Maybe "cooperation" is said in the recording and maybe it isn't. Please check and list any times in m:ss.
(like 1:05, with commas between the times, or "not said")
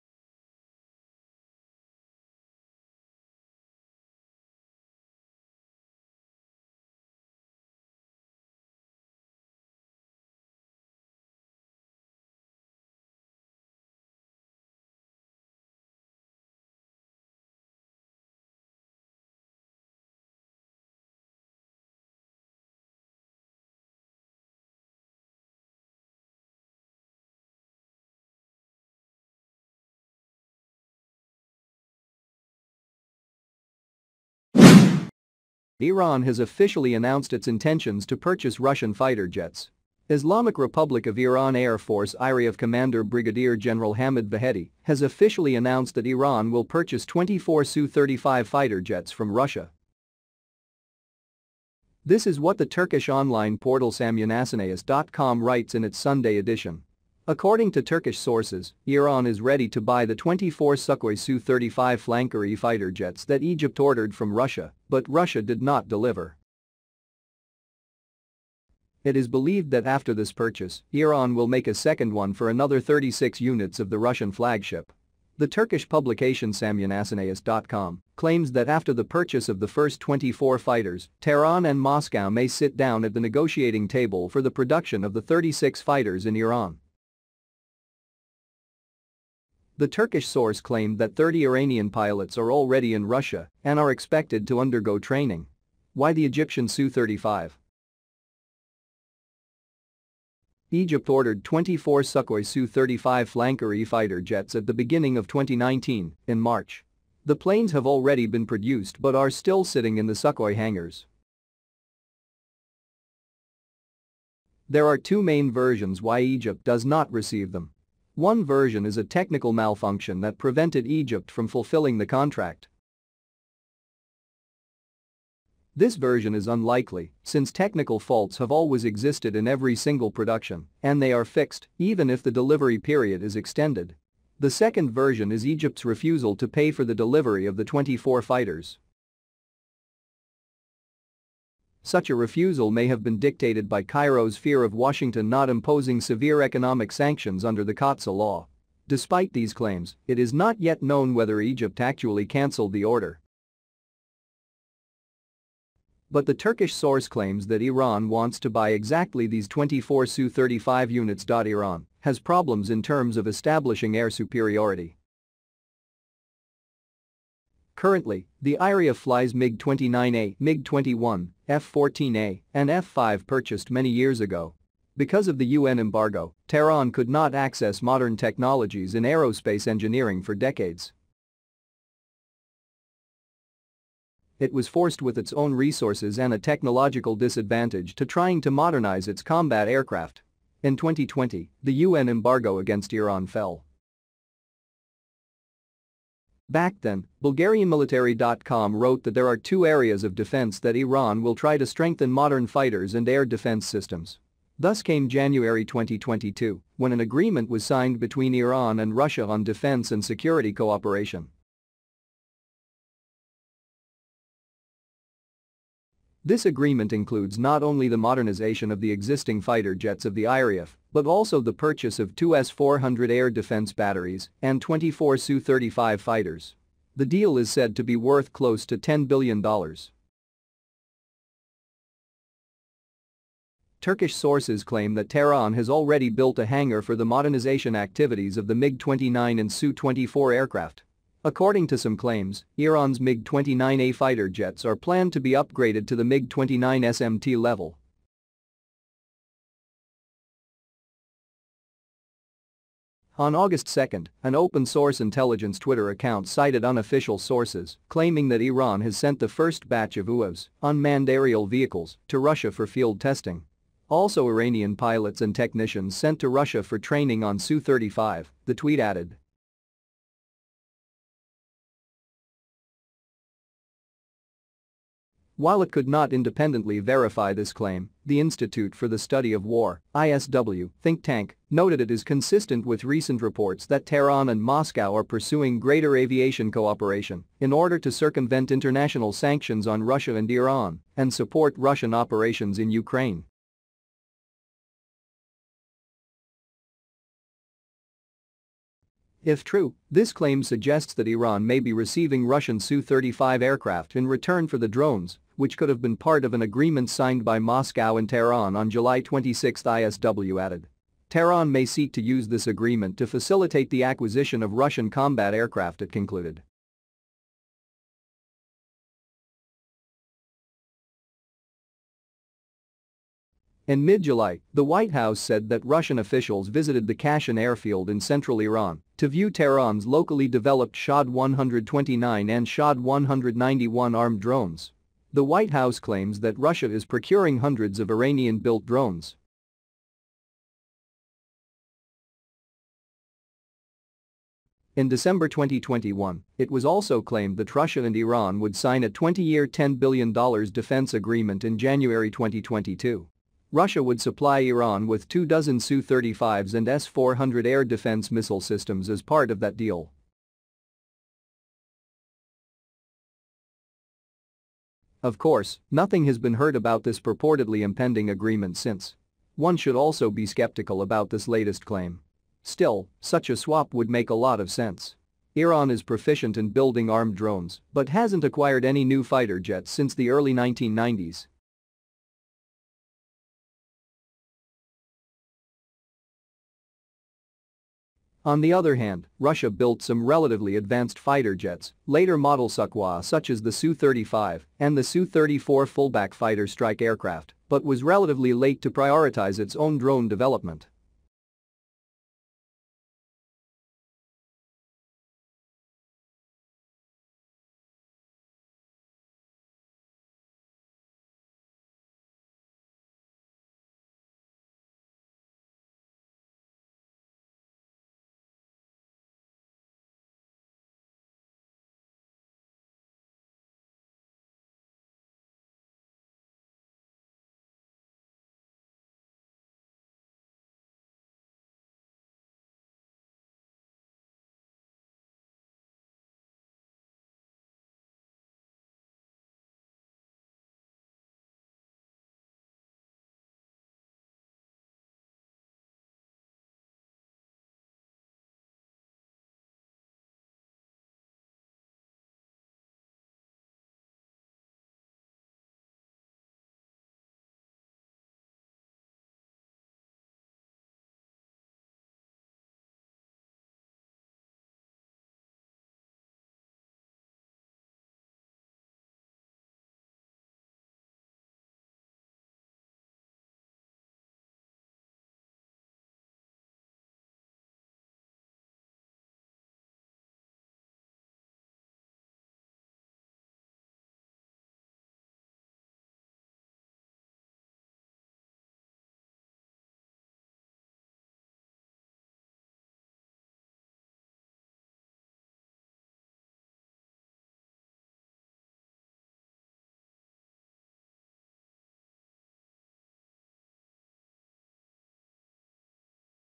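3:30, 4:46.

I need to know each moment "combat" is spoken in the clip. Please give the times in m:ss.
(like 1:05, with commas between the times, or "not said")
3:09, 5:14.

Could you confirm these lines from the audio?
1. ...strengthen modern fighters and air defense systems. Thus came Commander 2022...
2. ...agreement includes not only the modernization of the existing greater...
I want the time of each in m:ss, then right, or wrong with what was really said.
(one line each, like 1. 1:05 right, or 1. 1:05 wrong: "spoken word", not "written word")
1. 3:21 wrong: "January", not "Commander"
2. 3:36 wrong: "fighter", not "greater".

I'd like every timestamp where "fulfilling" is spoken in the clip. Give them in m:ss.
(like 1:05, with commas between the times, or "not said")
2:01.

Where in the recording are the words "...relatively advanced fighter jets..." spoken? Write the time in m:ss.
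6:30.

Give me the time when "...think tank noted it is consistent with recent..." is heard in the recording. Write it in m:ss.
4:40.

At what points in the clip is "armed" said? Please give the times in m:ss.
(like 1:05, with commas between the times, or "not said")
5:33, 6:16.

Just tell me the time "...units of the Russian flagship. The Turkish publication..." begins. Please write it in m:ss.
1:13.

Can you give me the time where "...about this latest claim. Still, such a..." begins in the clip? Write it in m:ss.
6:10.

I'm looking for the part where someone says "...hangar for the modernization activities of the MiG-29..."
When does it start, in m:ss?
3:56.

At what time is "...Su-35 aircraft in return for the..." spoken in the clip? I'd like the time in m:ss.
5:02.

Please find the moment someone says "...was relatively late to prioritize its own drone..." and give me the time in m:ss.
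6:37.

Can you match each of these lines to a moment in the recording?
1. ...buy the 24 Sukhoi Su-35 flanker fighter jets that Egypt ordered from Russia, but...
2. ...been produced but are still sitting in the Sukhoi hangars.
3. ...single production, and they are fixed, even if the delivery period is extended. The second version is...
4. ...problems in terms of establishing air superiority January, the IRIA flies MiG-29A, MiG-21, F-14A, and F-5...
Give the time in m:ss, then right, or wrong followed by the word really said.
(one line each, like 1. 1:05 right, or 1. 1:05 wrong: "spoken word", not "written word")
1. 0:59 right
2. 1:48 right
3. 2:09 right
4. 2:42 wrong: "Currently", not "January".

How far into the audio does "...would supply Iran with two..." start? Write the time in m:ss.
5:53.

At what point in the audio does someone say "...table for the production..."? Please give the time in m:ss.
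1:23.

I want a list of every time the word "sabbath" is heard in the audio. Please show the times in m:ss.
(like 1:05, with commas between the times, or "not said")
not said.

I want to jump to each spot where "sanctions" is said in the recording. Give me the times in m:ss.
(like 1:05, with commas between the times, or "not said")
2:26, 4:49.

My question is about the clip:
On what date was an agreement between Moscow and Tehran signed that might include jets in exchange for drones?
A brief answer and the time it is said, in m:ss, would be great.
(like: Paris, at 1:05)
July 26, at 5:08.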